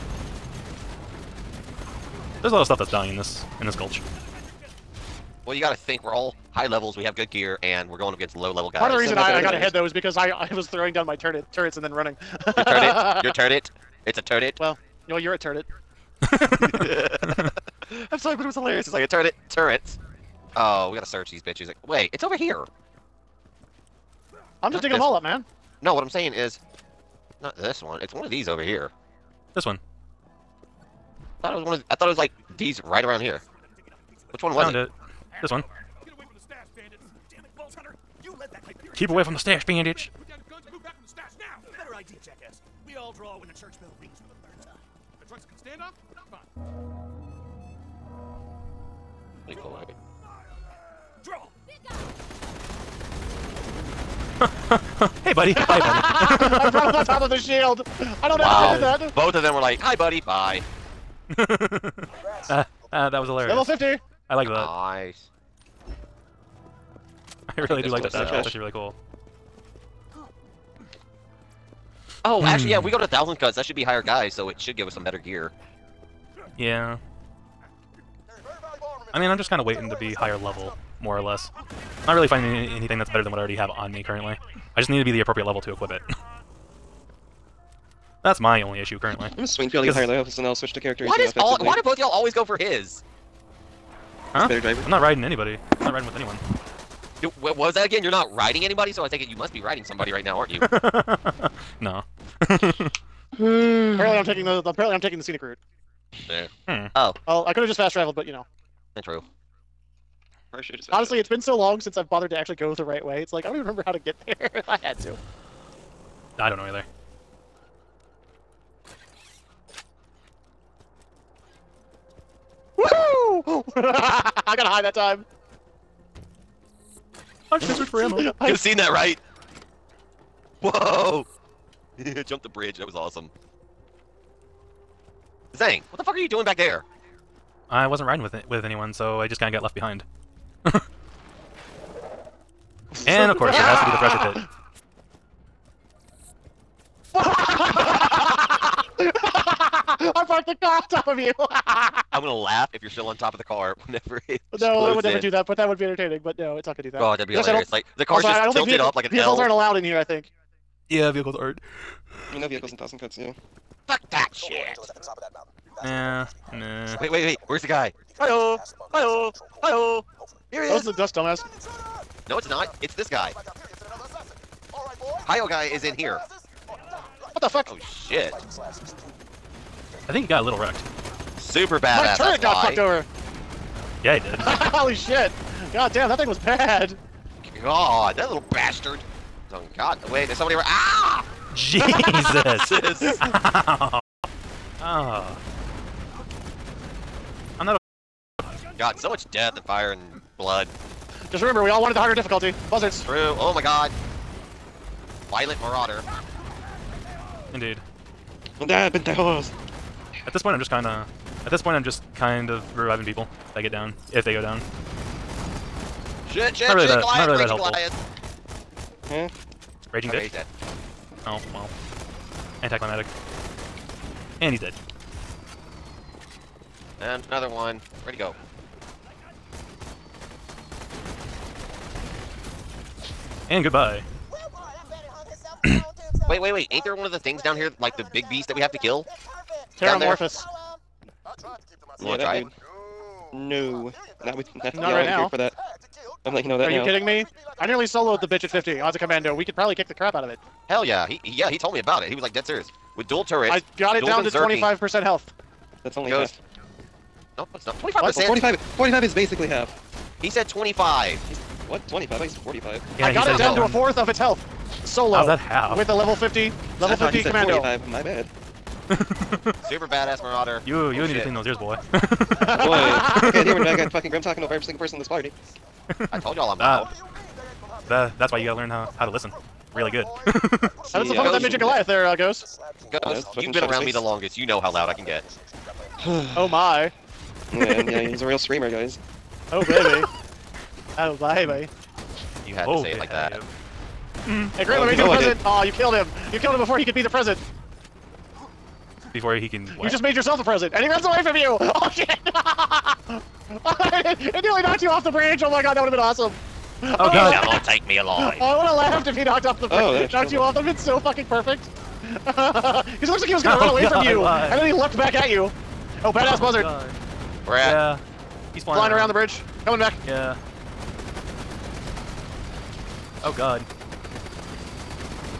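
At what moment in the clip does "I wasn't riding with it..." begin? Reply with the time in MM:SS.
02:17.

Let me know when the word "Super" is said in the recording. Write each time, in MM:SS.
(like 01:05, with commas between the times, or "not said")
03:01, 04:28.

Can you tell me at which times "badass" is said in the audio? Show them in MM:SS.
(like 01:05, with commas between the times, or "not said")
03:01, 04:29, 05:16.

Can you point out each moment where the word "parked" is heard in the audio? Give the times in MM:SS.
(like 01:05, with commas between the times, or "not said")
02:30.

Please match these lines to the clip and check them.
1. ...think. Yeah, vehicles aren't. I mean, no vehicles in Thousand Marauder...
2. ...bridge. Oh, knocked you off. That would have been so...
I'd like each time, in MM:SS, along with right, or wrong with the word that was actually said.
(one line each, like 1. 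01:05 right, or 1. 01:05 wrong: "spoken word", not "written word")
1. 02:40 wrong: "Cuts", not "Marauder"
2. 05:09 right.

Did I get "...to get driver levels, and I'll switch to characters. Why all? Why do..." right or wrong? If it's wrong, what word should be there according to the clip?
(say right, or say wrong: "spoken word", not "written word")
wrong: "higher", not "driver".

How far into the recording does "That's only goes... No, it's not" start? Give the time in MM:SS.
04:15.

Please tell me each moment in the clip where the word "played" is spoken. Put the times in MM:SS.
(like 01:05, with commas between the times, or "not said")
not said.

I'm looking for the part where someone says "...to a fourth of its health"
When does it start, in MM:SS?
04:23.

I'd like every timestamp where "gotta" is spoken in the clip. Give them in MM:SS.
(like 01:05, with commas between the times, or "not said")
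00:05, 00:20, 04:38.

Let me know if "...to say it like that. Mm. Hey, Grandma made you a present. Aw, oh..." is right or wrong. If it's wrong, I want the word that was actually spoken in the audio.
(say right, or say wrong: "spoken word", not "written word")
right.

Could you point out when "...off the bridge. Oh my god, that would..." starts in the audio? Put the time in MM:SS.
05:04.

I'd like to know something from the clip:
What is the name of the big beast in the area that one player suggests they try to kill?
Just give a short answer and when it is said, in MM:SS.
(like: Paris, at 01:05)
Terramorphous, at 03:59.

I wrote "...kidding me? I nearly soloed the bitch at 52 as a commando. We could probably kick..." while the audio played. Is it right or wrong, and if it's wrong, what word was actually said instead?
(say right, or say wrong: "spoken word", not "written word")
wrong: "50", not "52".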